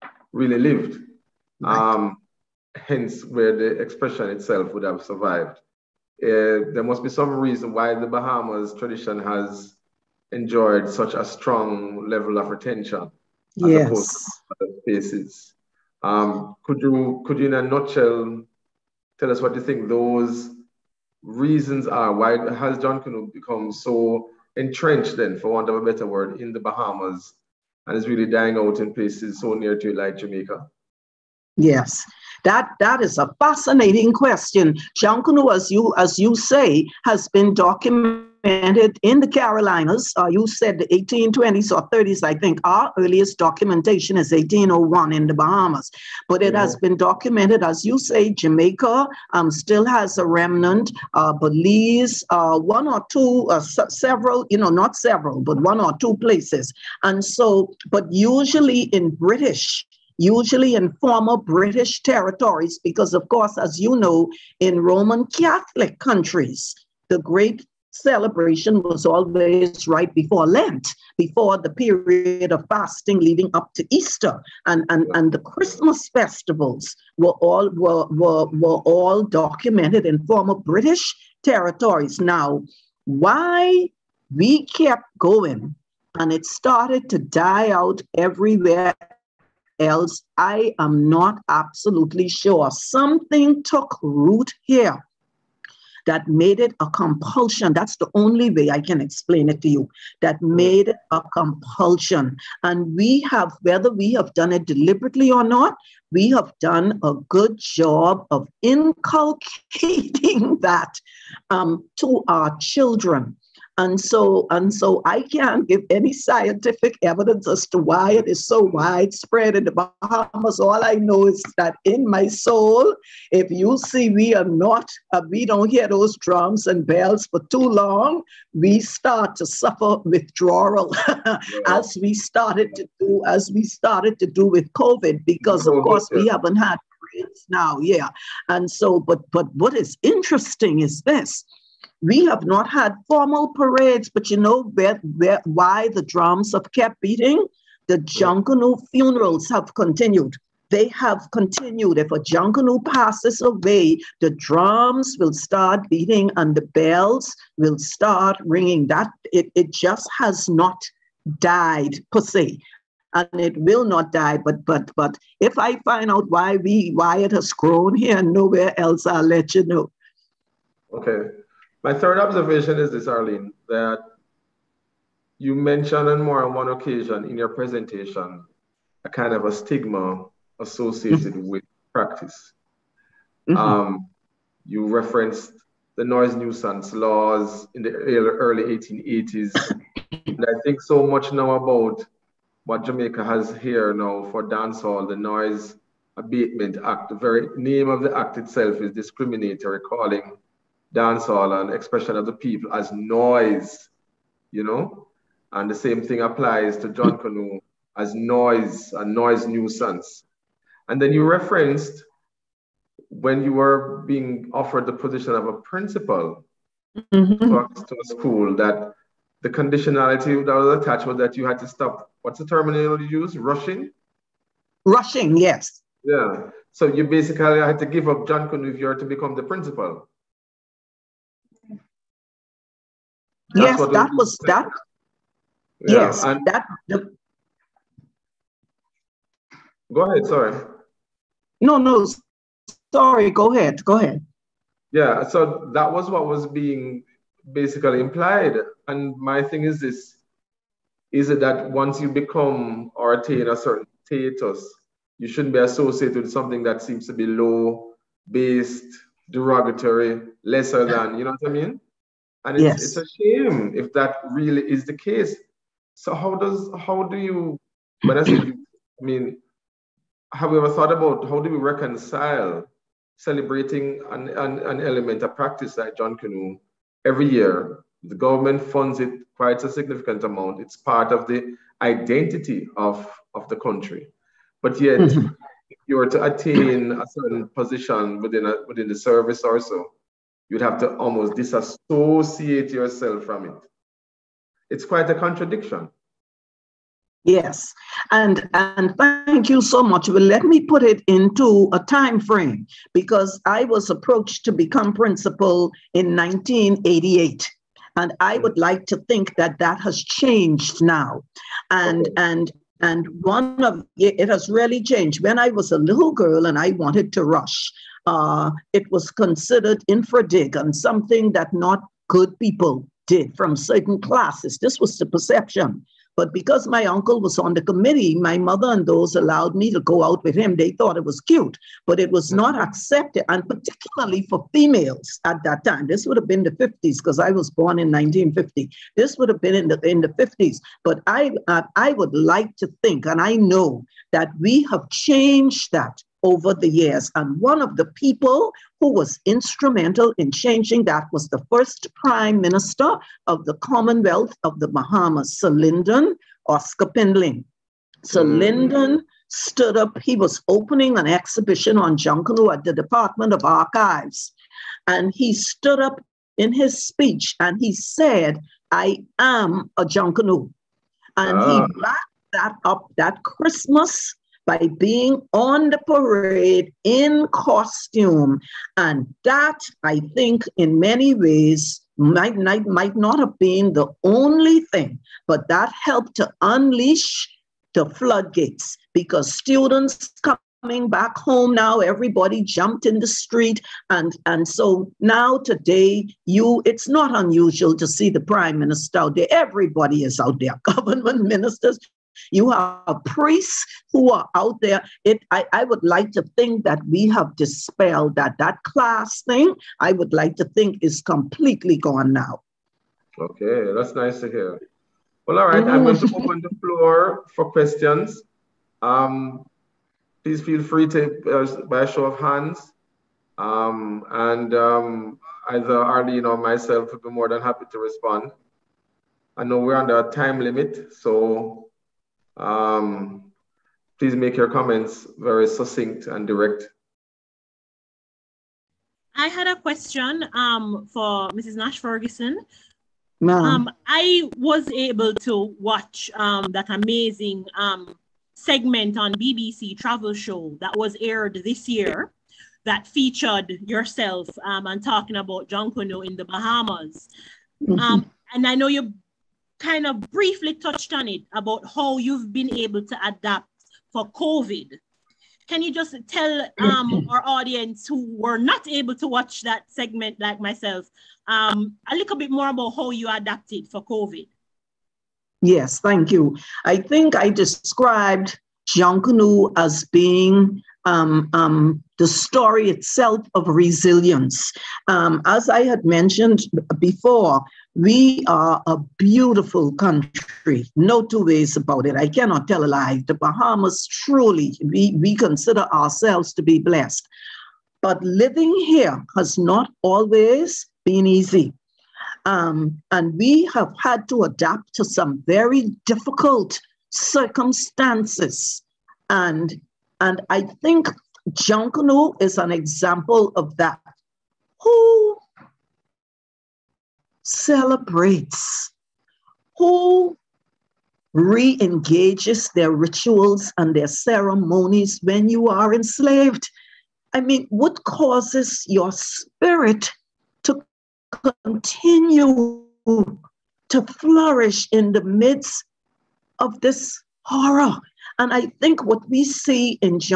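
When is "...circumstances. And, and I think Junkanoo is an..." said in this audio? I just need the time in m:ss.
8:26.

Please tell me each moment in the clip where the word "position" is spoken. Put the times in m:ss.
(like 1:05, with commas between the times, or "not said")
3:34, 4:47.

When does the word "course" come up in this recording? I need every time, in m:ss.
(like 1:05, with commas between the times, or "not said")
1:03, 2:15.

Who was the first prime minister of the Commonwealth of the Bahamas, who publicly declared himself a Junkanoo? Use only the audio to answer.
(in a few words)
Sir Lyndon Oscar Pindling.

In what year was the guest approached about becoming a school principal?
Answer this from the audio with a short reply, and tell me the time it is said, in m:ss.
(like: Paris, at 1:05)
1988, at 5:06.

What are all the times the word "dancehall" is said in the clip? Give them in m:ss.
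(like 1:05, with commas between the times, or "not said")
3:14, 3:20.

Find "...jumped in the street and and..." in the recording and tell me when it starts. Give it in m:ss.
6:32.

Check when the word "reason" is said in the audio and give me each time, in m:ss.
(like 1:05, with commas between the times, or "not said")
0:07, 0:21.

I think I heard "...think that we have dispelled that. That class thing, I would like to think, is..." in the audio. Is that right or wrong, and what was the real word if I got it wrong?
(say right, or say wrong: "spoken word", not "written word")
right.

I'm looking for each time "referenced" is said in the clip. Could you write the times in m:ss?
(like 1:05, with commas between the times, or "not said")
3:04, 3:31.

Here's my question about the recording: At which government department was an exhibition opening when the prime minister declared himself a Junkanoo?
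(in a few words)
Department of Archives.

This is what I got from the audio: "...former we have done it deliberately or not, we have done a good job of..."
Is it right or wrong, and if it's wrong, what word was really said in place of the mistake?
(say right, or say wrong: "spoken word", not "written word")
wrong: "whether", not "former".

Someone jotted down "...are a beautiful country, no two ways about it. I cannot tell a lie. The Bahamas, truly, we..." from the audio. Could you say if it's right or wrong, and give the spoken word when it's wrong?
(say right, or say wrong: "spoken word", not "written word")
right.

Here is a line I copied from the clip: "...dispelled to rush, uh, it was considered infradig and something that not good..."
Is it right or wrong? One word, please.
wrong.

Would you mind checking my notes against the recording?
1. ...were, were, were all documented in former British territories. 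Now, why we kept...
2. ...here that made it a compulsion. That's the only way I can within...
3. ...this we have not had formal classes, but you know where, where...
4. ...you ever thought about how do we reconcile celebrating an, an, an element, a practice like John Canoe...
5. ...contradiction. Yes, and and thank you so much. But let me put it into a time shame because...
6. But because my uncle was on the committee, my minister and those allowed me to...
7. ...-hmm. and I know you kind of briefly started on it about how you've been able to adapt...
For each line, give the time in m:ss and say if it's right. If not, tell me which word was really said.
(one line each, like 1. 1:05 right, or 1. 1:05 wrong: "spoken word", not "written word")
1. 1:17 right
2. 1:34 wrong: "explain", not "within"
3. 2:21 wrong: "parades", not "classes"
4. 4:30 right
5. 4:55 wrong: "frame", not "shame"
6. 5:26 wrong: "mother", not "minister"
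7. 7:37 wrong: "touched", not "started".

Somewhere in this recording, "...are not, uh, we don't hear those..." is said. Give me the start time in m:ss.
2:04.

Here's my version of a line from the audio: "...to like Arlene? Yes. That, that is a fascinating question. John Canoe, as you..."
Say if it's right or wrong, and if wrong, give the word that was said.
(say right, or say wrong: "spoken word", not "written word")
wrong: "Jamaica", not "Arlene".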